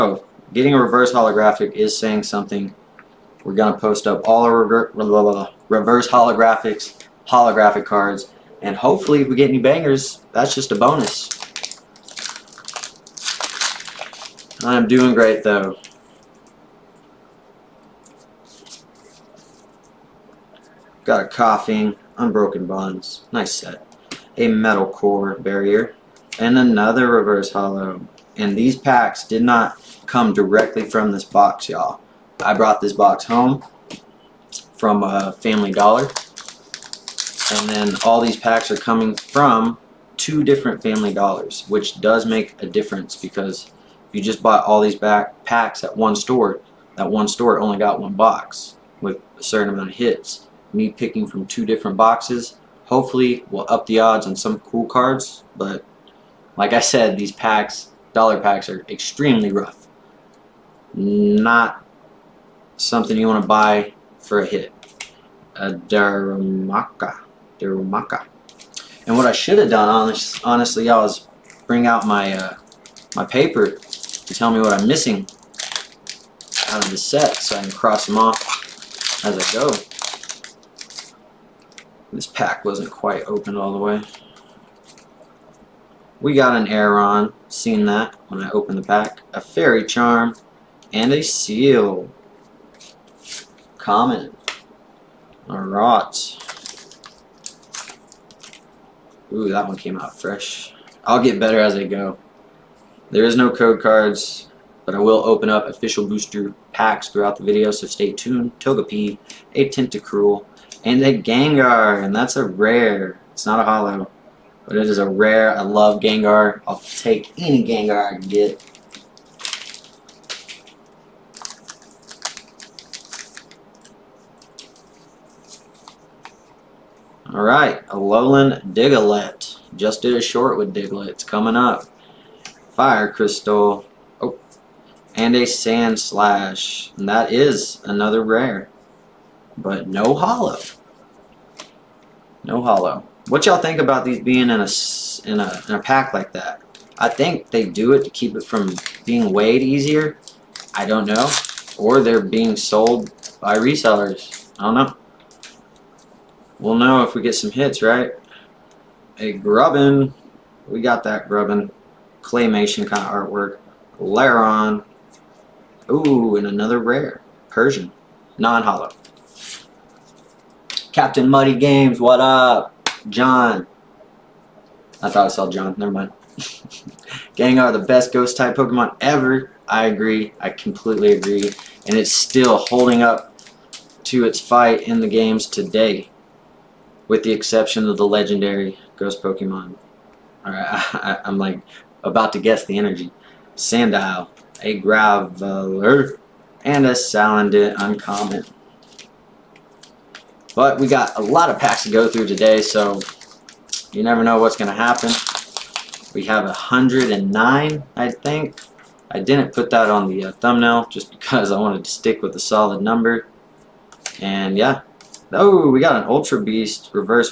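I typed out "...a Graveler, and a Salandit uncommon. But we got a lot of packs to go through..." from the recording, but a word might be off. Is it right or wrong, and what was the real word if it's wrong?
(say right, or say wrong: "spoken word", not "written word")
right.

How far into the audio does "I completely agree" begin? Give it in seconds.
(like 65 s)
180 s.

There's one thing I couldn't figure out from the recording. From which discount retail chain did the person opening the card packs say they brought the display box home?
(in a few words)
Family Dollar.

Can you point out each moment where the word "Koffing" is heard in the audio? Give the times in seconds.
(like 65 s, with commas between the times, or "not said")
21 s.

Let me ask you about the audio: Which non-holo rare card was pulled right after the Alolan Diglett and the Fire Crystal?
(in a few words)
Sandslash.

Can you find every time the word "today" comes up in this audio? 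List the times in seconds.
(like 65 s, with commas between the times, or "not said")
185 s, 202 s.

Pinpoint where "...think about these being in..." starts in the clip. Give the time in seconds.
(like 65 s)
143 s.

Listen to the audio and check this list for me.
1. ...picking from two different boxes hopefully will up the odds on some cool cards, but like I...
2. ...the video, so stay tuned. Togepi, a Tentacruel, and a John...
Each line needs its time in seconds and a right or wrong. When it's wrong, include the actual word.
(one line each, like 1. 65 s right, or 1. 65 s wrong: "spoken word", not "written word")
1. 50 s right
2. 107 s wrong: "Gengar", not "John".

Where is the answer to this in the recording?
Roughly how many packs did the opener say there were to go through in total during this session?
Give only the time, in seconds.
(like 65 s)
206 s.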